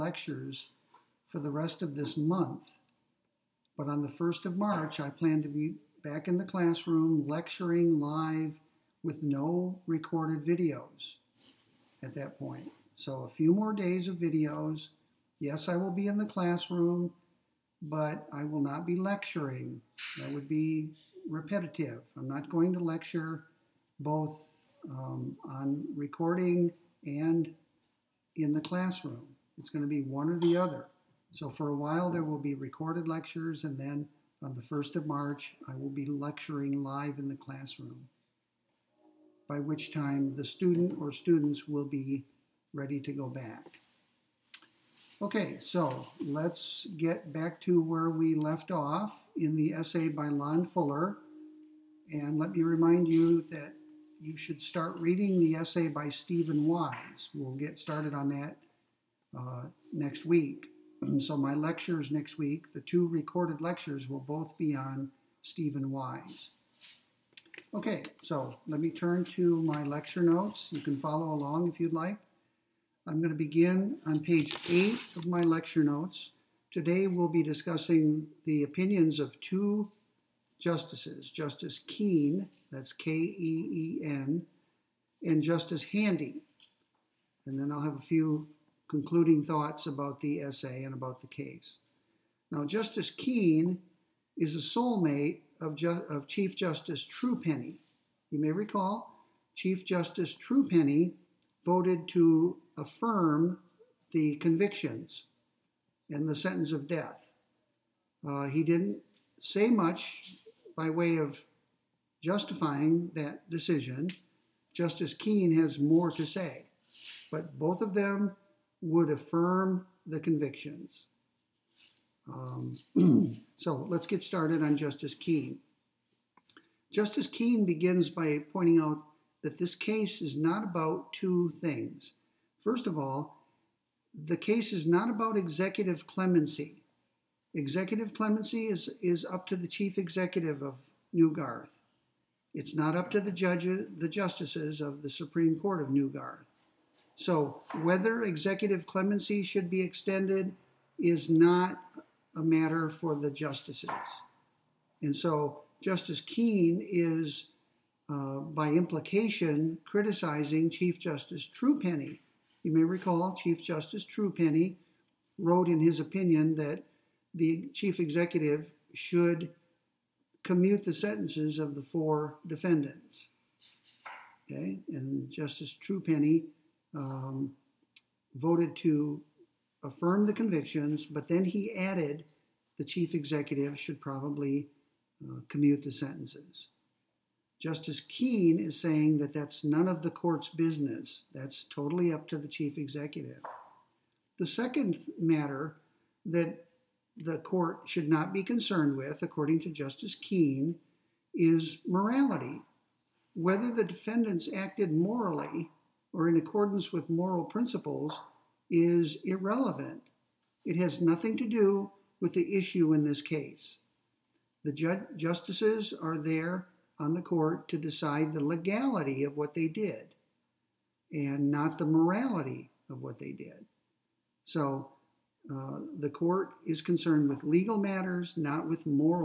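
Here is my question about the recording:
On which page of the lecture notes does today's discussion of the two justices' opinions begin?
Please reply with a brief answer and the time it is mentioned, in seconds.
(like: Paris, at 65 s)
8, at 74 s.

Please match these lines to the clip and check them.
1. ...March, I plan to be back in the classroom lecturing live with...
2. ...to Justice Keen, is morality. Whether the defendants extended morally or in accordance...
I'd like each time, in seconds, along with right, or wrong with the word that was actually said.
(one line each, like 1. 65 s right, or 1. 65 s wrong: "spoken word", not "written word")
1. 4 s right
2. 199 s wrong: "acted", not "extended".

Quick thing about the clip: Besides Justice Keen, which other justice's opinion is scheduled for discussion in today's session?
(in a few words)
Justice Handy.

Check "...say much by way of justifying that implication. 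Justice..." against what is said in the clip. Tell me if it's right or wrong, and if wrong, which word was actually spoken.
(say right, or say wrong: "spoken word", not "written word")
wrong: "decision", not "implication".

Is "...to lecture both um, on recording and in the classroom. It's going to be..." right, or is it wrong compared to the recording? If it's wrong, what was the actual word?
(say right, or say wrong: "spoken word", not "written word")
right.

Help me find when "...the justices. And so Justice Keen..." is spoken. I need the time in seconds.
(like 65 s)
153 s.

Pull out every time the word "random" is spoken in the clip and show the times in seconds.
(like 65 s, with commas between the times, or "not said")
not said.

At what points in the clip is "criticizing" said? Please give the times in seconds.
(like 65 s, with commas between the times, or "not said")
159 s.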